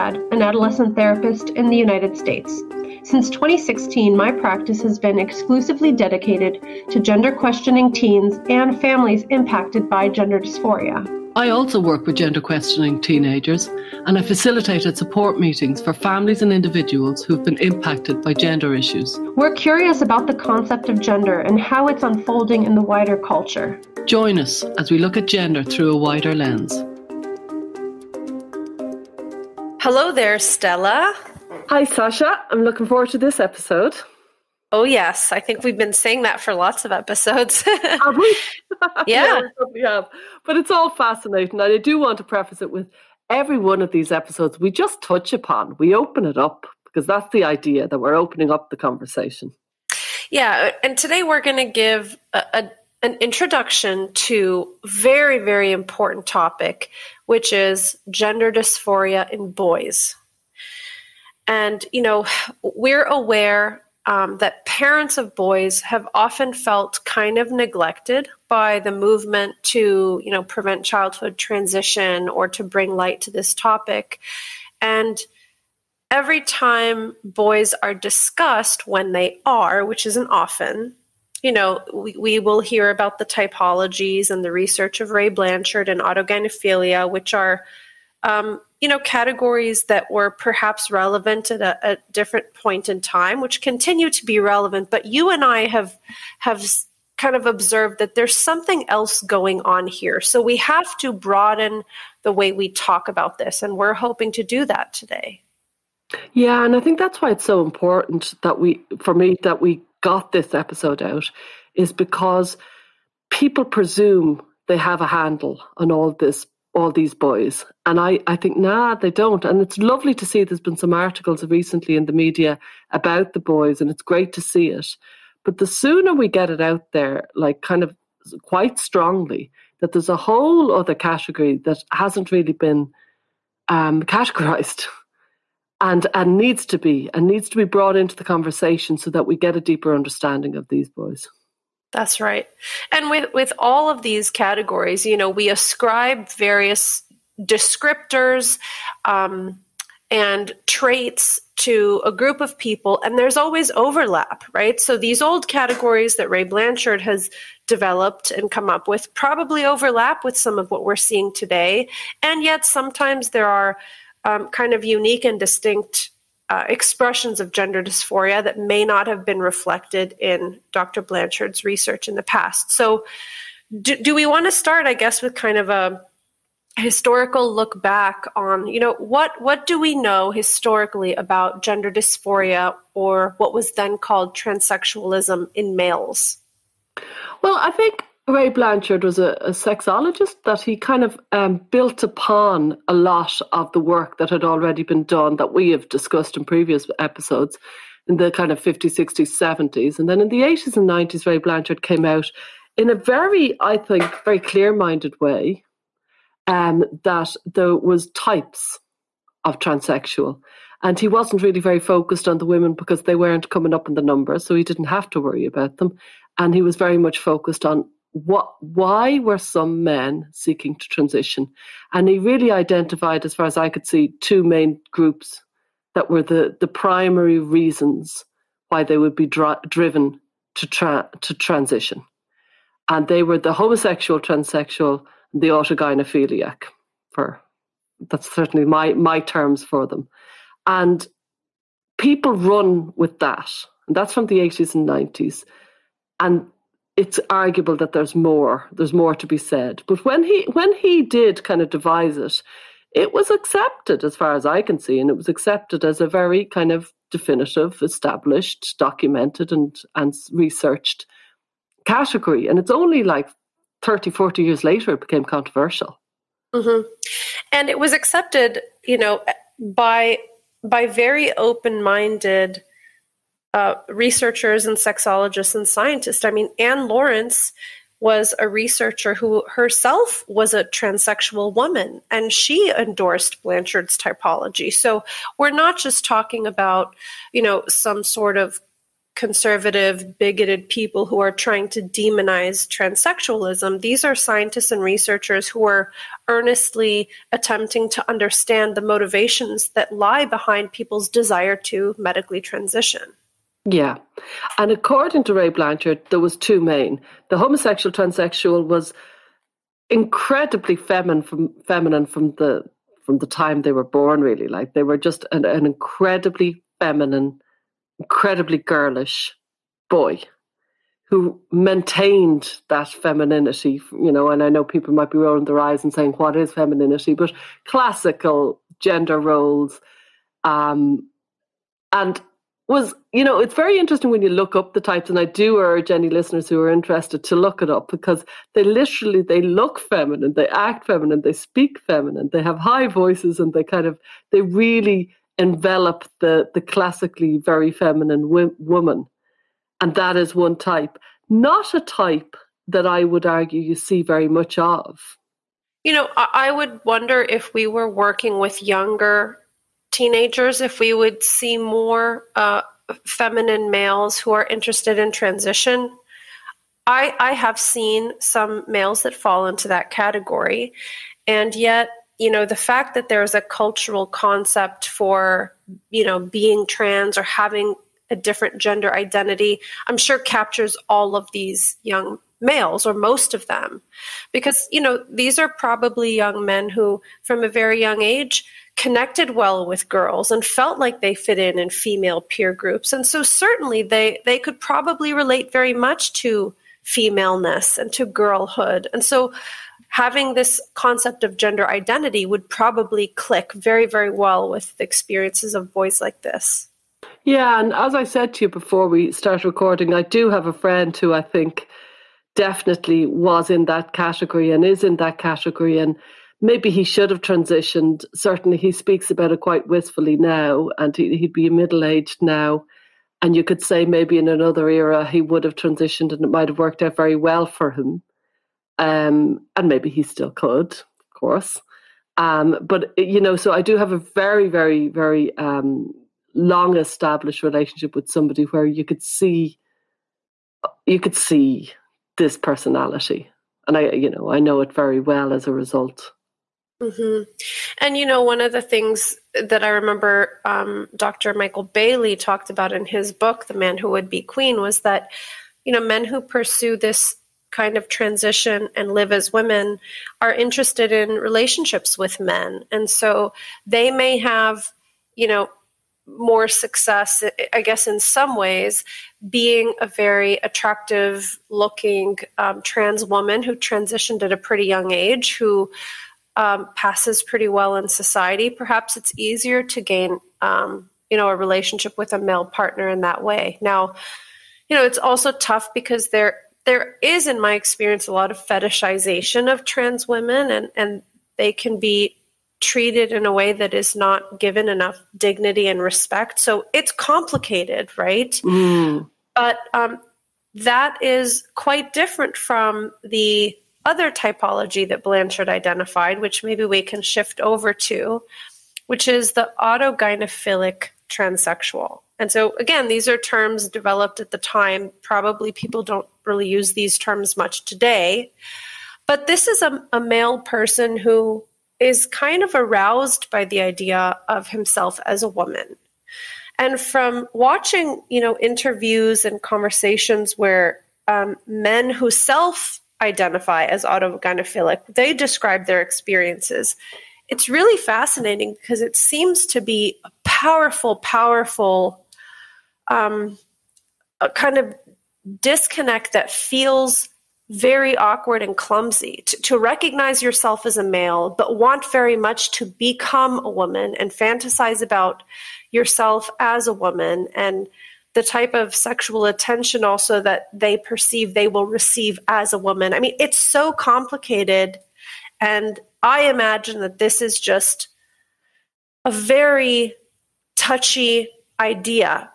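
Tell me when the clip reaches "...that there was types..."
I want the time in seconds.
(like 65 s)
207 s.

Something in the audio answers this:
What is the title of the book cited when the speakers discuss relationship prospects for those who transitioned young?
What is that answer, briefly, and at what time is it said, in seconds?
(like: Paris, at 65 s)
The Man Who Would Be Queen, at 453 s.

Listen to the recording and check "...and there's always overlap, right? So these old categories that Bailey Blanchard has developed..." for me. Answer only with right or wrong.
wrong.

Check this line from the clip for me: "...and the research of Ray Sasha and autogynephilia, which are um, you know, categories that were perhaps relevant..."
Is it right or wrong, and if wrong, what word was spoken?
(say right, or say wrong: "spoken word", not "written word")
wrong: "Blanchard", not "Sasha".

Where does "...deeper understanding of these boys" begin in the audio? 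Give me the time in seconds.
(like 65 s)
139 s.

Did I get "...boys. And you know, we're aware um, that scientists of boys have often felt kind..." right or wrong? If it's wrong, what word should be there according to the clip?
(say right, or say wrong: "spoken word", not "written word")
wrong: "parents", not "scientists".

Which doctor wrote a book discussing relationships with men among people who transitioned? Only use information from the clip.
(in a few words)
Michael Bailey.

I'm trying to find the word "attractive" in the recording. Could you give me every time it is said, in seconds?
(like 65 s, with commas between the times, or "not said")
470 s.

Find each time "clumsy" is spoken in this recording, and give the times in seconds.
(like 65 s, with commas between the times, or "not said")
548 s.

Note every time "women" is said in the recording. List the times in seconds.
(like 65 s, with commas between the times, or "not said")
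212 s, 459 s, 490 s.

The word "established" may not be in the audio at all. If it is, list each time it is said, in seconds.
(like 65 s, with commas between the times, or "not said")
257 s, 436 s.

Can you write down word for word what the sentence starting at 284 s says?
So we're not just talking about, you know, some sort of conservative, bigoted people who are trying to demonize transsexualism.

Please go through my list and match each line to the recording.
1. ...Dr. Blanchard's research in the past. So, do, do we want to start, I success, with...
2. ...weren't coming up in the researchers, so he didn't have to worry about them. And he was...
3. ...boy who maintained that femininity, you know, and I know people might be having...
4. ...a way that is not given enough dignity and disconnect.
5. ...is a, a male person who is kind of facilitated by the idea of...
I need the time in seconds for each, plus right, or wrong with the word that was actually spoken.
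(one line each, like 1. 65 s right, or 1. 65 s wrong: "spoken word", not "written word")
1. 170 s wrong: "guess", not "success"
2. 213 s wrong: "numbers", not "researchers"
3. 319 s wrong: "rolling", not "having"
4. 493 s wrong: "respect", not "disconnect"
5. 519 s wrong: "aroused", not "facilitated".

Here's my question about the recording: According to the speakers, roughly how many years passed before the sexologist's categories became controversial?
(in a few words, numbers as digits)
30 to 40 years.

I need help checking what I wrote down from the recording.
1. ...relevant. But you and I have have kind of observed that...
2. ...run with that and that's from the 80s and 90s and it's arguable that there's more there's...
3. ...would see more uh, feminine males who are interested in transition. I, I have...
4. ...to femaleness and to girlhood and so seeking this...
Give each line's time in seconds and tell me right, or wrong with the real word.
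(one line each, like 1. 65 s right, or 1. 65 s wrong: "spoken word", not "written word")
1. 94 s right
2. 242 s right
3. 360 s right
4. 396 s wrong: "having", not "seeking".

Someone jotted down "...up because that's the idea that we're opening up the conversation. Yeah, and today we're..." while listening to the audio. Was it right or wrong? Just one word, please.
right.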